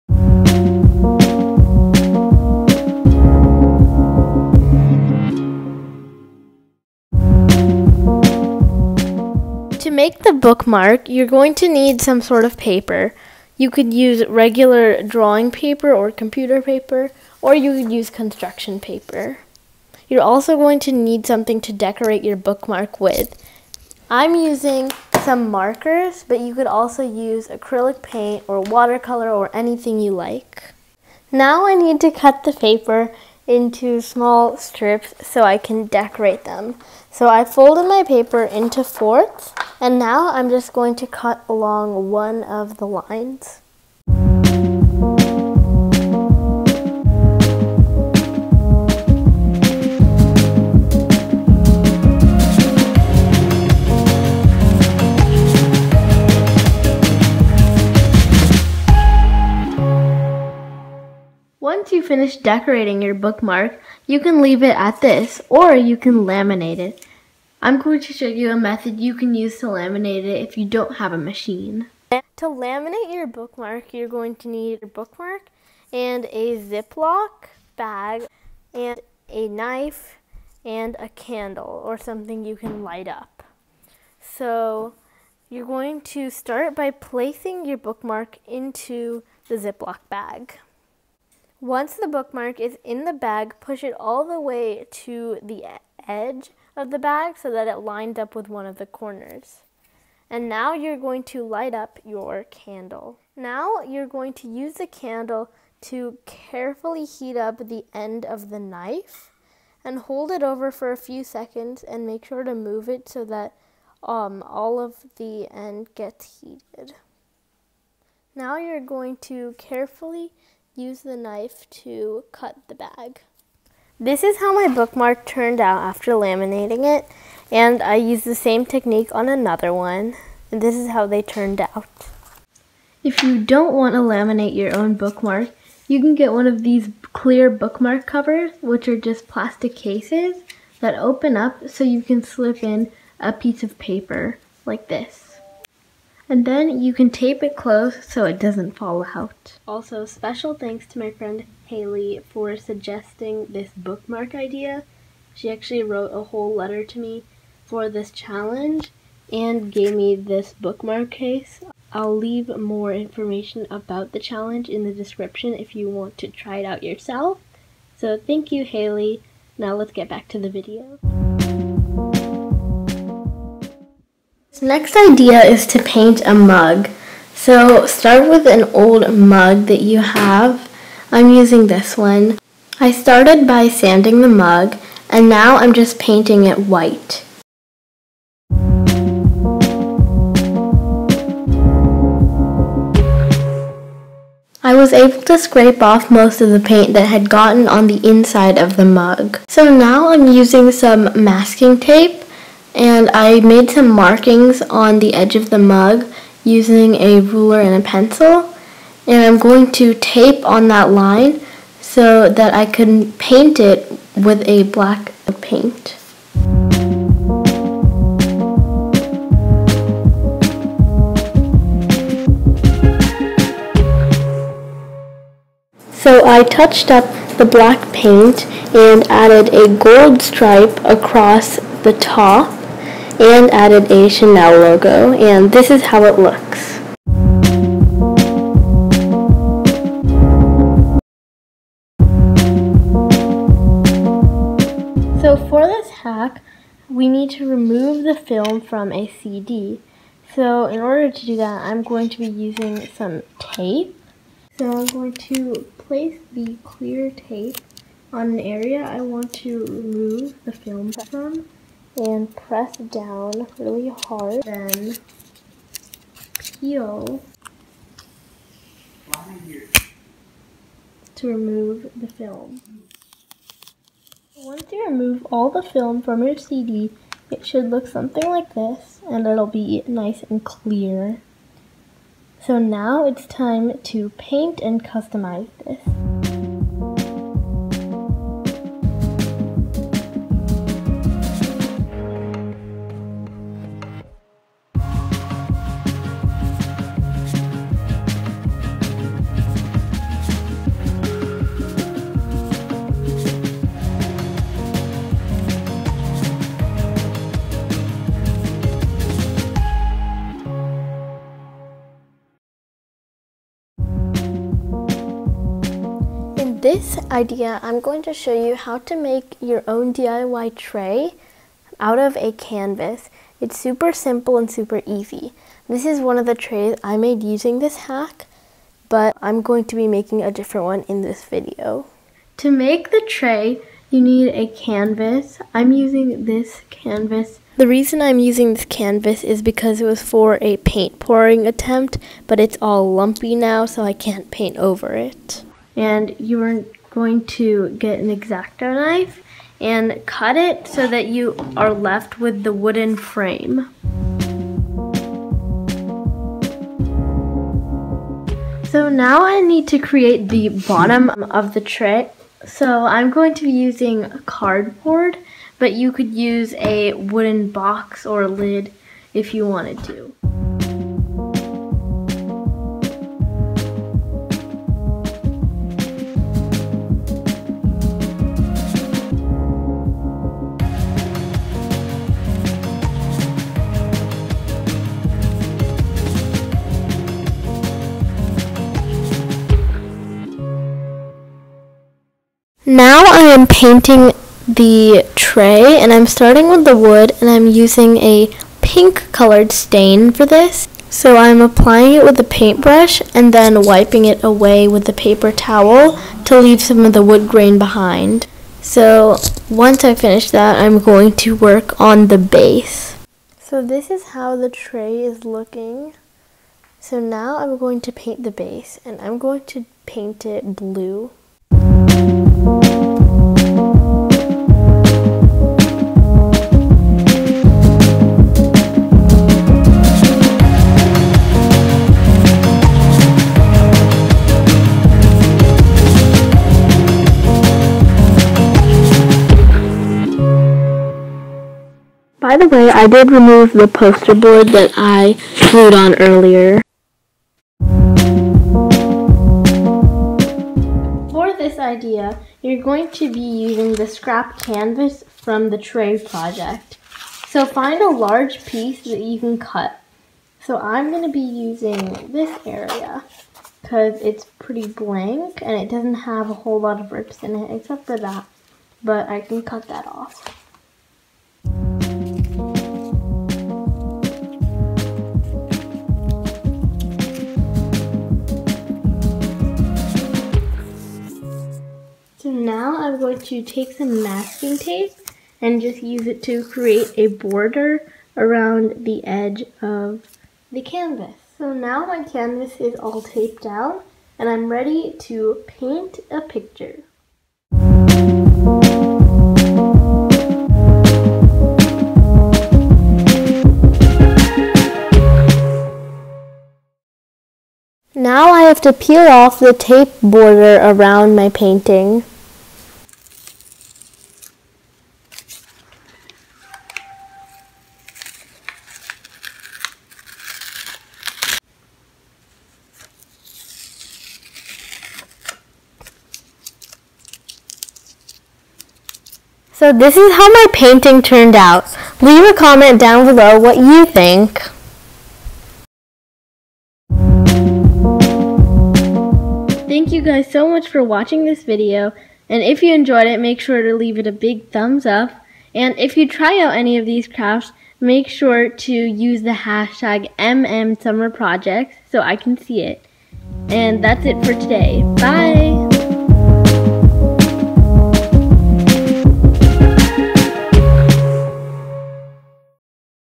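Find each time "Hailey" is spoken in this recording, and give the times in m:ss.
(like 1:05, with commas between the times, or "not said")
2:31, 2:48.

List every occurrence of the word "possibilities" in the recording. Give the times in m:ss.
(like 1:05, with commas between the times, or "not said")
not said.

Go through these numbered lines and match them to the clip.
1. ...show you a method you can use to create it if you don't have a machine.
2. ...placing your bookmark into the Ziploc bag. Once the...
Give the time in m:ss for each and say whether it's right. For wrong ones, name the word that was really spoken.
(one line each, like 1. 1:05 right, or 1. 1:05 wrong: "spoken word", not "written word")
1. 1:08 wrong: "laminate", not "create"
2. 1:26 right.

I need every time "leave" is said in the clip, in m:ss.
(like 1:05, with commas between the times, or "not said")
1:04, 2:42, 6:46, 8:52, 9:03.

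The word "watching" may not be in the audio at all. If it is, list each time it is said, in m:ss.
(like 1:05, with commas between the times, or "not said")
9:00.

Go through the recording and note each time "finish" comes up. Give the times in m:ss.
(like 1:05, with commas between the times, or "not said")
1:02, 6:49.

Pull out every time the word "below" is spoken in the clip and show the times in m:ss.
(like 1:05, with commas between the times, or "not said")
8:53.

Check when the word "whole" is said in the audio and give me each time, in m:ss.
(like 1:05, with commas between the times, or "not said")
2:36, 7:46.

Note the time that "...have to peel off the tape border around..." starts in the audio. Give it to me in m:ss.
8:28.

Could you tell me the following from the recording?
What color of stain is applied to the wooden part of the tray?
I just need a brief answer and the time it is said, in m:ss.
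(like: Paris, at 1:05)
pink, at 6:38.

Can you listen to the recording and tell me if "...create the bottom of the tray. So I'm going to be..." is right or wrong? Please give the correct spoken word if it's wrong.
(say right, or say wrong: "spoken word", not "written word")
right.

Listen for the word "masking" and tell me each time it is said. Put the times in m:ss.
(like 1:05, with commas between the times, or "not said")
3:21, 8:04.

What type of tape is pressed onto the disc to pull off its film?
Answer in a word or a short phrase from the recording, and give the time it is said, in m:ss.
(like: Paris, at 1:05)
clear tape, at 4:16.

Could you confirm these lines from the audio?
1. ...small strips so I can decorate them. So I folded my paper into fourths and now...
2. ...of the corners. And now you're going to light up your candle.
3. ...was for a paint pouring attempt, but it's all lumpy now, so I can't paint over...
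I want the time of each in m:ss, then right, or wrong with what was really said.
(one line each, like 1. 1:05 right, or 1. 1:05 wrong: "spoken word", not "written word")
1. 0:34 right
2. 1:38 right
3. 5:39 right.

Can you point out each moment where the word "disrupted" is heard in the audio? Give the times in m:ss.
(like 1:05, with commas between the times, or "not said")
not said.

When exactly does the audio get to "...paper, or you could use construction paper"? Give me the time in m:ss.
0:16.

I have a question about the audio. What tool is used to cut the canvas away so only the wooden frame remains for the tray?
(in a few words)
X-Acto knife.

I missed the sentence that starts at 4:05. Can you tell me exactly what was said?
So for this hack, we need to remove the film from a CD.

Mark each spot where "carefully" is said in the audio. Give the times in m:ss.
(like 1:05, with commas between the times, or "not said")
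1:46, 1:59.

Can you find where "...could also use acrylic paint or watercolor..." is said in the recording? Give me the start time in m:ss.
0:26.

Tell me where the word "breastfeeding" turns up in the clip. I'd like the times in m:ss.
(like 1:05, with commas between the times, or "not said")
not said.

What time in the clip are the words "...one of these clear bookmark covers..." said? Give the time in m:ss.
2:16.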